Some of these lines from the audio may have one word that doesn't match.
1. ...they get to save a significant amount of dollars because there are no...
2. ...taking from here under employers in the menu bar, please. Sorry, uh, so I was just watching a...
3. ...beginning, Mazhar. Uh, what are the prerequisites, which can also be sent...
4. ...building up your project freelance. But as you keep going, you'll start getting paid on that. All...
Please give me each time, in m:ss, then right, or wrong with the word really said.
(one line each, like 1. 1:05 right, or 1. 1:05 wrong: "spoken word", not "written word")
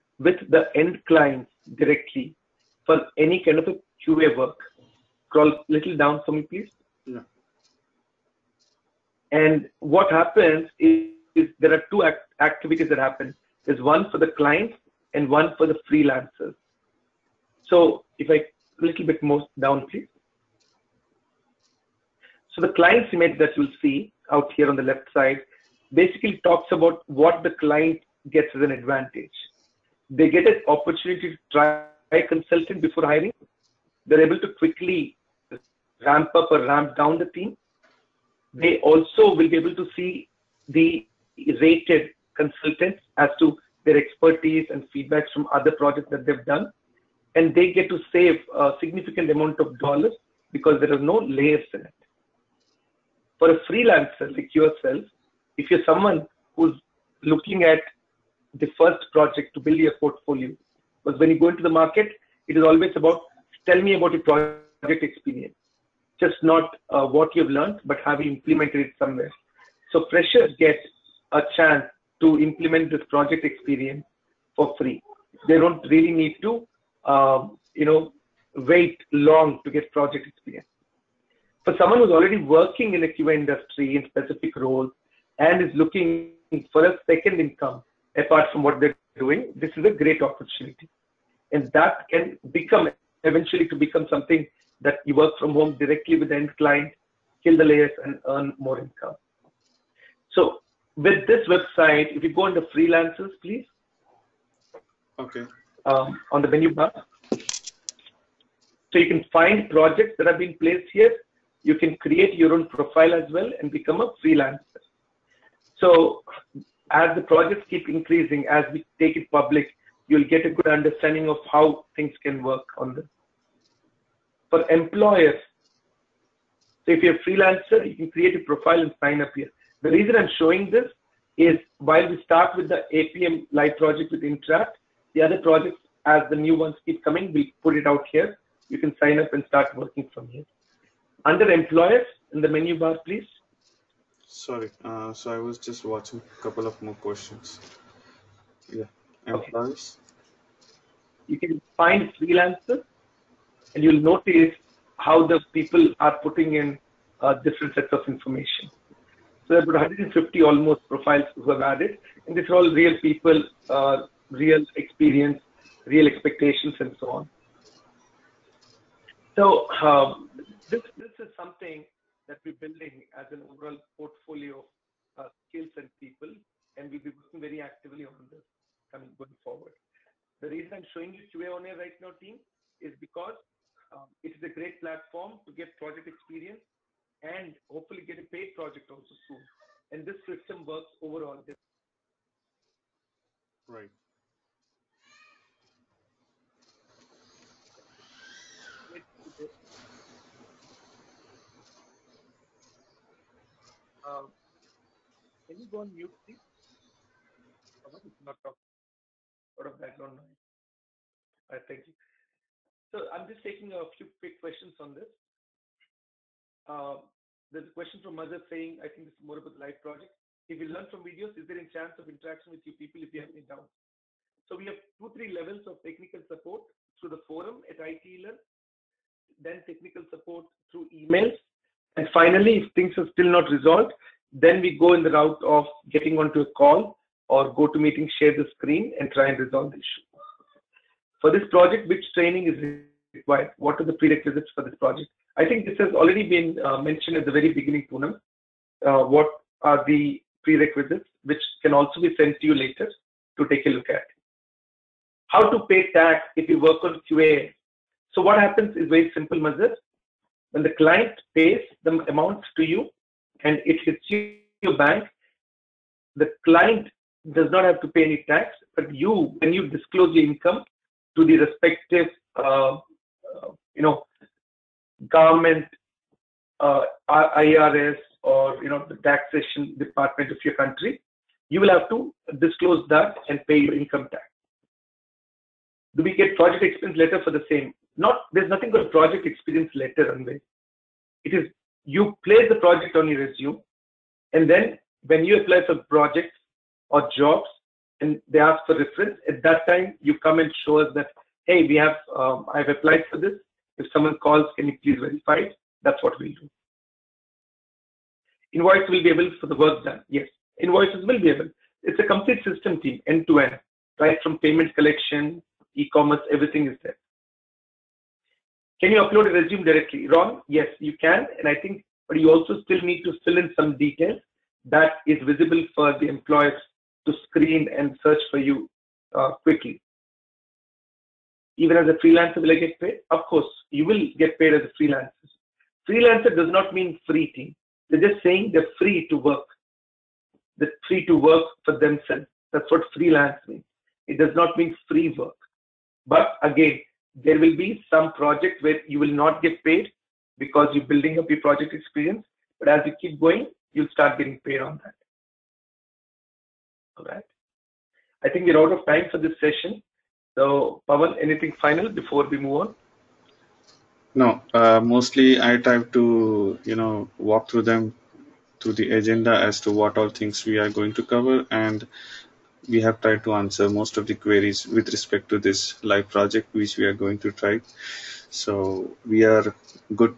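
1. 0:47 right
2. 2:19 wrong: "working", not "taking"
3. 4:07 wrong: "Poonam", not "Mazhar"
4. 5:50 wrong: "experience", not "freelance".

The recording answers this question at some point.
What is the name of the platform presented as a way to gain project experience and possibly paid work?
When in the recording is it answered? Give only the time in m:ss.
3:01.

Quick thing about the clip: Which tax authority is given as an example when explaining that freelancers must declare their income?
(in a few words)
IRS.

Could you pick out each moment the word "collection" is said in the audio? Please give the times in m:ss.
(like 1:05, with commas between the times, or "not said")
5:14.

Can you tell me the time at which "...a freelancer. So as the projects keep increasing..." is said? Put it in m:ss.
1:53.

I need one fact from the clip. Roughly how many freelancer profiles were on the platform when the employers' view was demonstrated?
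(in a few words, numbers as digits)
150.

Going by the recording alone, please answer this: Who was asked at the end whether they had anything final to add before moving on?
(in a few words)
Pavan.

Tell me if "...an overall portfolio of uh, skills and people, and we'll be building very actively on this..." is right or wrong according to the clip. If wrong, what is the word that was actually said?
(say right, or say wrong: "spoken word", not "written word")
wrong: "working", not "building".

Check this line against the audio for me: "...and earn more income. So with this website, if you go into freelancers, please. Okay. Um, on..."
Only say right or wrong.
right.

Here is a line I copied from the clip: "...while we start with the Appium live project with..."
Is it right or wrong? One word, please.
right.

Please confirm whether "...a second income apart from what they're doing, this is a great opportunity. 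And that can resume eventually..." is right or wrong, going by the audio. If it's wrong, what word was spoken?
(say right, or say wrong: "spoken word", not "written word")
wrong: "become", not "resume".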